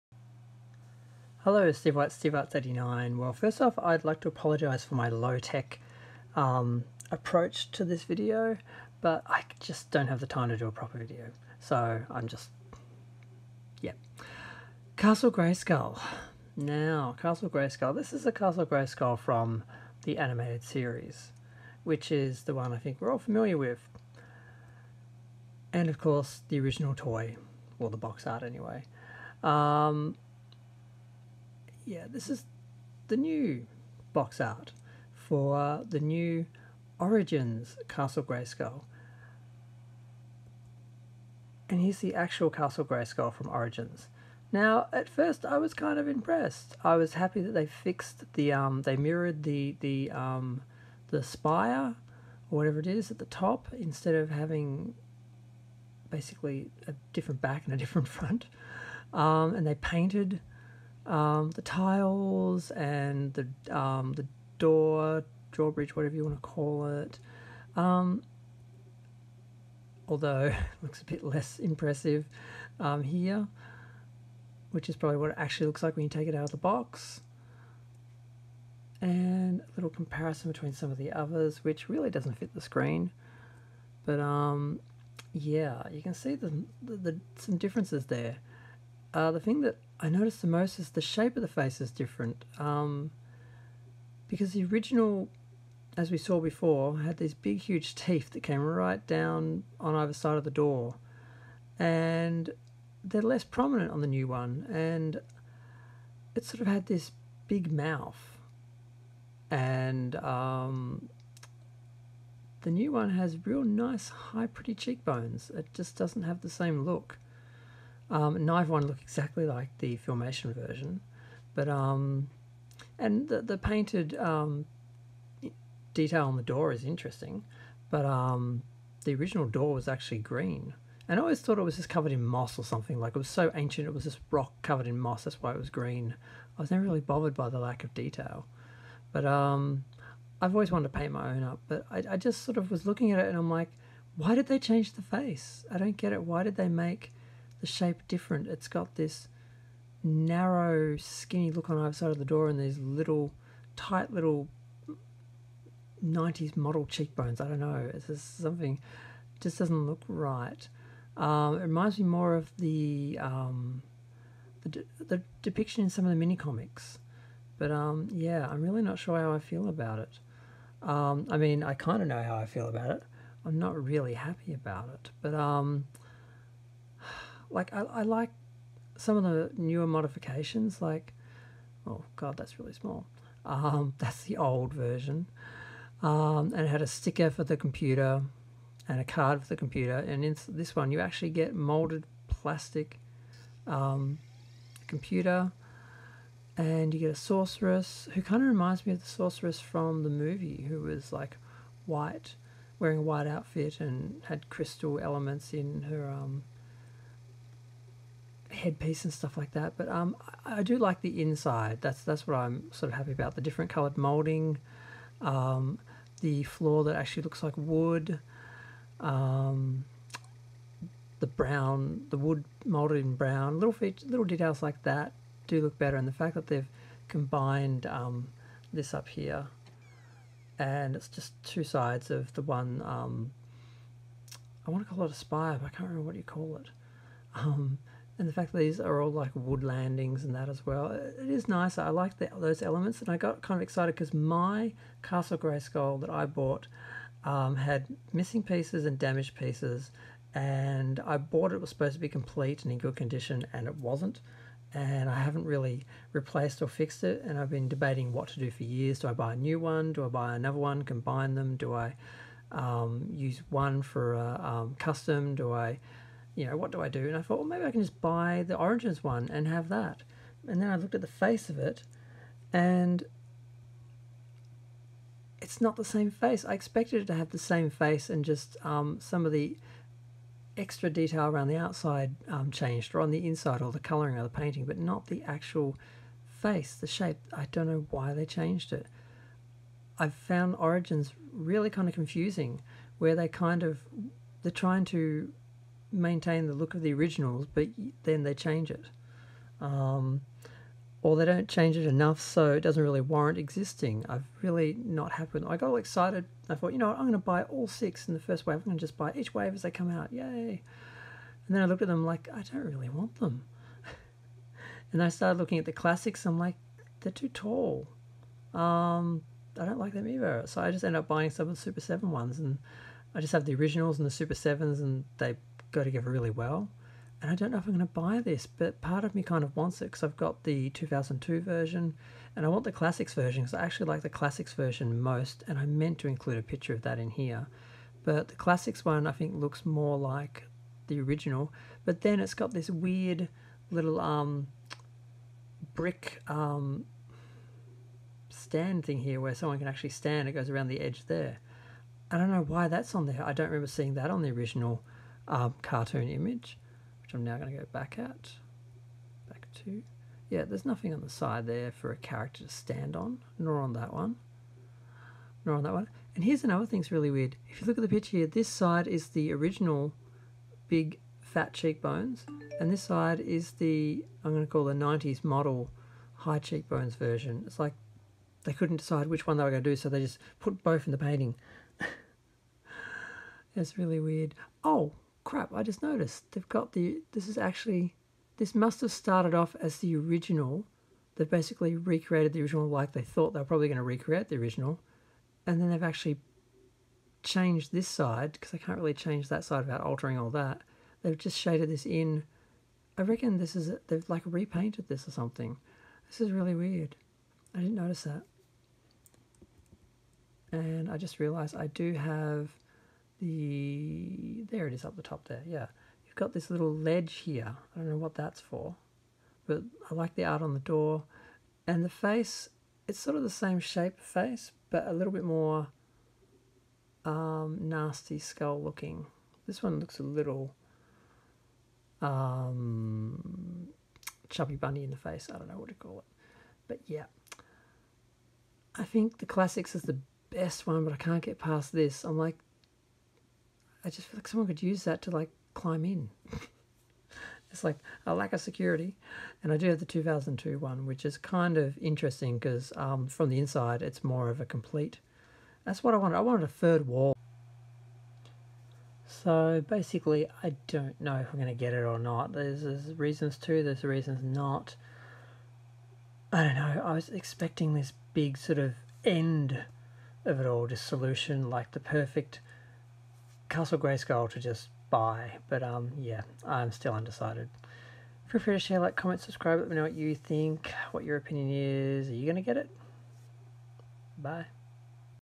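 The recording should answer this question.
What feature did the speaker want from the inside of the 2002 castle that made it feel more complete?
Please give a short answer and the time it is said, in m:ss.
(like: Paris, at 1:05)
a third wall, at 7:36.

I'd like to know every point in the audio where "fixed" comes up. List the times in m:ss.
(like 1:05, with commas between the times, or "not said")
0:47, 4:16.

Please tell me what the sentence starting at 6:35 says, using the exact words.
And then they've actually changed this side, because I can't really change that side without altering all that.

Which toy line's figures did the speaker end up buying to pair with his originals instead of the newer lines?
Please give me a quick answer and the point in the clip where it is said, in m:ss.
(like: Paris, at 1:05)
Super 7, at 5:21.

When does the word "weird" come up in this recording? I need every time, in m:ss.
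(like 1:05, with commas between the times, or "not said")
5:42, 6:07, 6:23, 6:46.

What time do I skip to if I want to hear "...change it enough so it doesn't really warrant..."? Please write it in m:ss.
5:01.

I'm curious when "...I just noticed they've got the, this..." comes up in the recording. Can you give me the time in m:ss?
6:25.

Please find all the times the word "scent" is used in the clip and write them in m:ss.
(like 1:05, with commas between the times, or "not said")
not said.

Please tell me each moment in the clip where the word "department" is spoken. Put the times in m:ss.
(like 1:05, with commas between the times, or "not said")
not said.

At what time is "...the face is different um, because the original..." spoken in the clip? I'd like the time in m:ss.
1:31.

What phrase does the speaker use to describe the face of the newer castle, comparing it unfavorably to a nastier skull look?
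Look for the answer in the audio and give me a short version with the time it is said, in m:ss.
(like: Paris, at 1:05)
chubby bunny, at 7:14.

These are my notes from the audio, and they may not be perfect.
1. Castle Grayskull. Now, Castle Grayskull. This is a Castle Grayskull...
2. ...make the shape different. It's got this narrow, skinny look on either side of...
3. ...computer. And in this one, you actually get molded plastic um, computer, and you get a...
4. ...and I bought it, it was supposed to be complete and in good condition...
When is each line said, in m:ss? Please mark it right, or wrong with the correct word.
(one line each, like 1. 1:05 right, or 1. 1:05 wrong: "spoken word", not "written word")
1. 0:14 right
2. 2:26 right
3. 3:09 right
4. 4:10 right.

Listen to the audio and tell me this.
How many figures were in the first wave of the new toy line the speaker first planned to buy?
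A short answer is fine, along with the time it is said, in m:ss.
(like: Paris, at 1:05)
6, at 5:07.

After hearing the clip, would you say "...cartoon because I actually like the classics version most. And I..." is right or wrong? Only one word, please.
wrong.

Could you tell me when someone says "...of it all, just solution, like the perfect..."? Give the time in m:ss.
7:50.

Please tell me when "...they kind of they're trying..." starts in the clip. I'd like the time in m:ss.
4:53.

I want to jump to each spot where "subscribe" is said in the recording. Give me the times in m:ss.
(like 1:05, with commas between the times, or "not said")
7:59.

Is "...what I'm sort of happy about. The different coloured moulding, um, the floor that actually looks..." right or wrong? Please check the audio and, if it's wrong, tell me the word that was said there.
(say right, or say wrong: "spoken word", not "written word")
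right.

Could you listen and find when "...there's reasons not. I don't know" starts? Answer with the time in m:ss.
7:43.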